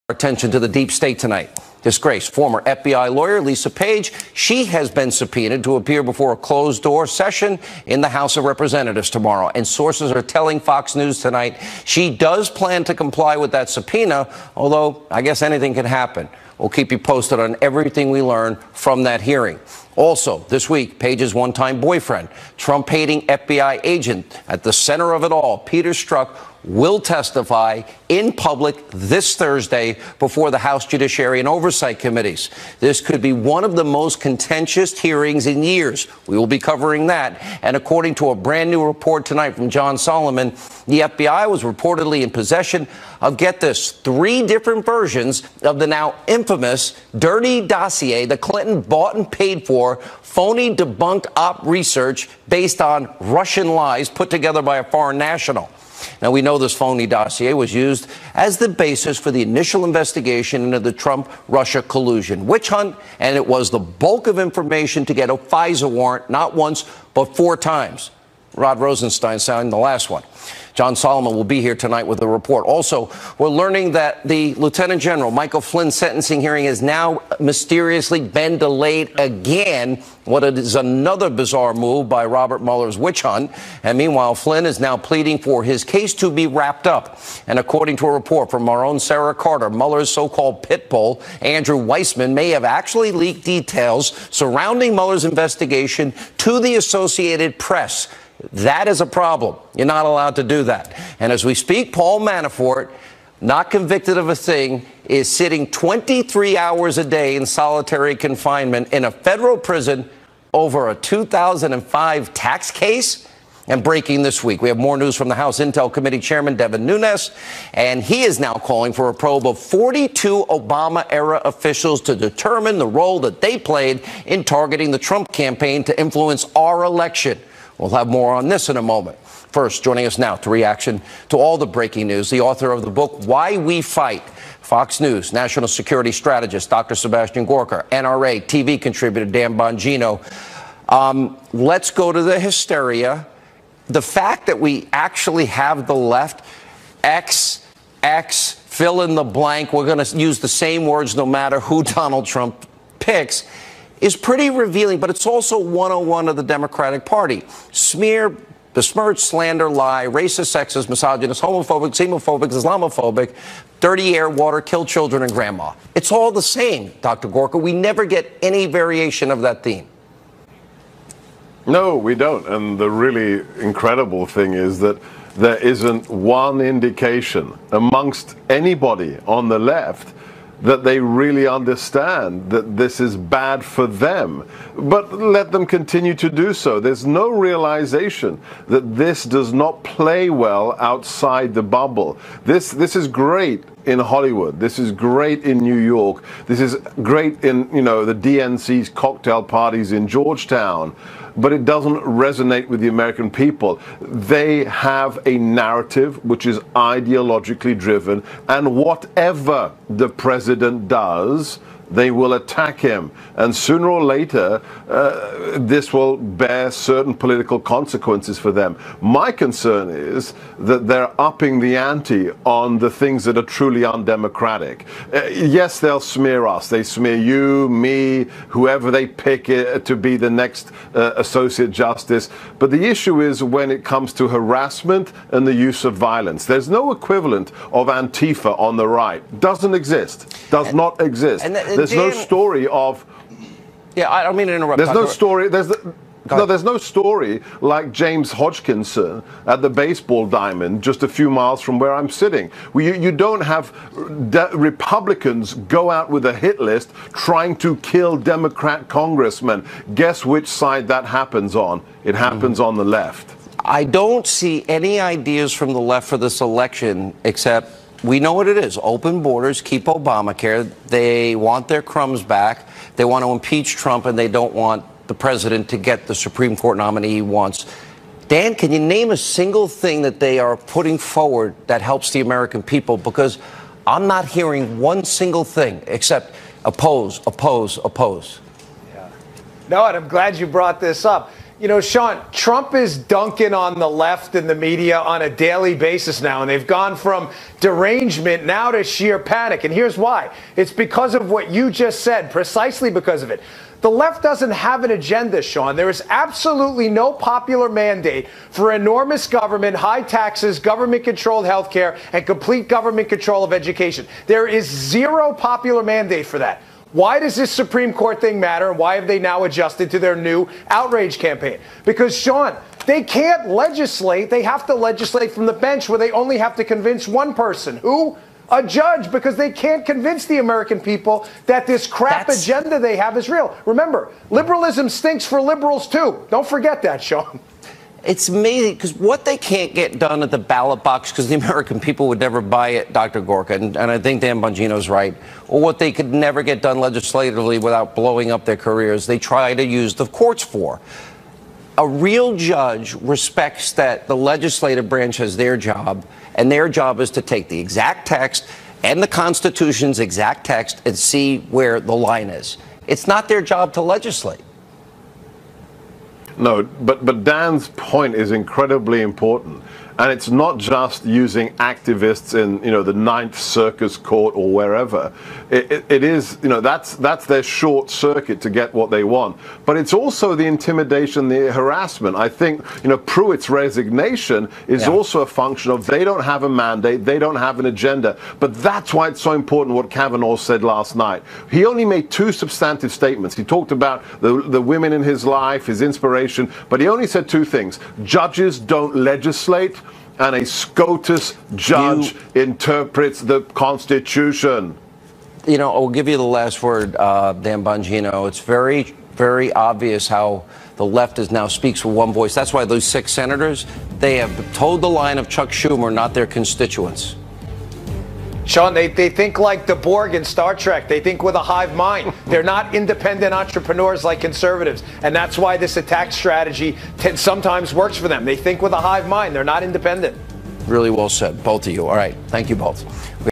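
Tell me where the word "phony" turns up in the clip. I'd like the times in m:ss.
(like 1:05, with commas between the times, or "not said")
0:50, 0:56.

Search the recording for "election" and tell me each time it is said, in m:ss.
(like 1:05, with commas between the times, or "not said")
2:06, 4:26.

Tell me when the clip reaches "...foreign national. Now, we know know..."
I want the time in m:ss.
0:54.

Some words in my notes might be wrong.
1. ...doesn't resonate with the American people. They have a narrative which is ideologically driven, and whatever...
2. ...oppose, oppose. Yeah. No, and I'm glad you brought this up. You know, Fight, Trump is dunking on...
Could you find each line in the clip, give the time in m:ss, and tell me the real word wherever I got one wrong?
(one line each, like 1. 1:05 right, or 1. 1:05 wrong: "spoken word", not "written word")
1. 3:21 right
2. 4:47 wrong: "Sean", not "Fight".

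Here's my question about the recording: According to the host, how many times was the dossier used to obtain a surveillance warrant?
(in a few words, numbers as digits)
4.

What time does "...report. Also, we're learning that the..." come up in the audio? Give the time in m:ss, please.
1:12.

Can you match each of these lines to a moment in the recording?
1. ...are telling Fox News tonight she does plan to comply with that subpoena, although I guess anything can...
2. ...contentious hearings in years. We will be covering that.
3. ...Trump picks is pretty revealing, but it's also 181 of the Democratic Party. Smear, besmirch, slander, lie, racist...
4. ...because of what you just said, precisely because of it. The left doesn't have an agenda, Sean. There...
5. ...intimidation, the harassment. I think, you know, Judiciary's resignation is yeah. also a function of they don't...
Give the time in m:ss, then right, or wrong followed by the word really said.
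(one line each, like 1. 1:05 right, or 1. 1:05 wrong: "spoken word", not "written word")
1. 0:10 right
2. 0:34 right
3. 2:32 wrong: "101", not "181"
4. 5:00 right
5. 6:20 wrong: "Pruitt", not "Judiciary".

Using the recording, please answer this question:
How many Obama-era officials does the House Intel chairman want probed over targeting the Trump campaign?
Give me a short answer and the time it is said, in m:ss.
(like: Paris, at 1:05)
42, at 1:59.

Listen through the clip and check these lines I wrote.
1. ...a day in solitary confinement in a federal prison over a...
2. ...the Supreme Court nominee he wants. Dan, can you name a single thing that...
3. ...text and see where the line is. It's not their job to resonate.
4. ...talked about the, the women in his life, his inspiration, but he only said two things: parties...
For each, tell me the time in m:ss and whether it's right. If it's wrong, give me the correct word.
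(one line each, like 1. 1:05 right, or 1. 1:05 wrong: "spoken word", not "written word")
1. 1:46 right
2. 4:36 right
3. 6:00 wrong: "legislate", not "resonate"
4. 6:33 wrong: "judges", not "parties".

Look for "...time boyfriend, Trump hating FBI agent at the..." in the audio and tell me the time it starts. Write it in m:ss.
0:21.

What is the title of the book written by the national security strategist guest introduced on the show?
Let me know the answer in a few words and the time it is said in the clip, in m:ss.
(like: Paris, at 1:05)
Why We Fight, at 2:13.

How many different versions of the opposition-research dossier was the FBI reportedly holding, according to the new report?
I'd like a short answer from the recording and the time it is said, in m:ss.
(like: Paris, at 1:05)
3, at 0:43.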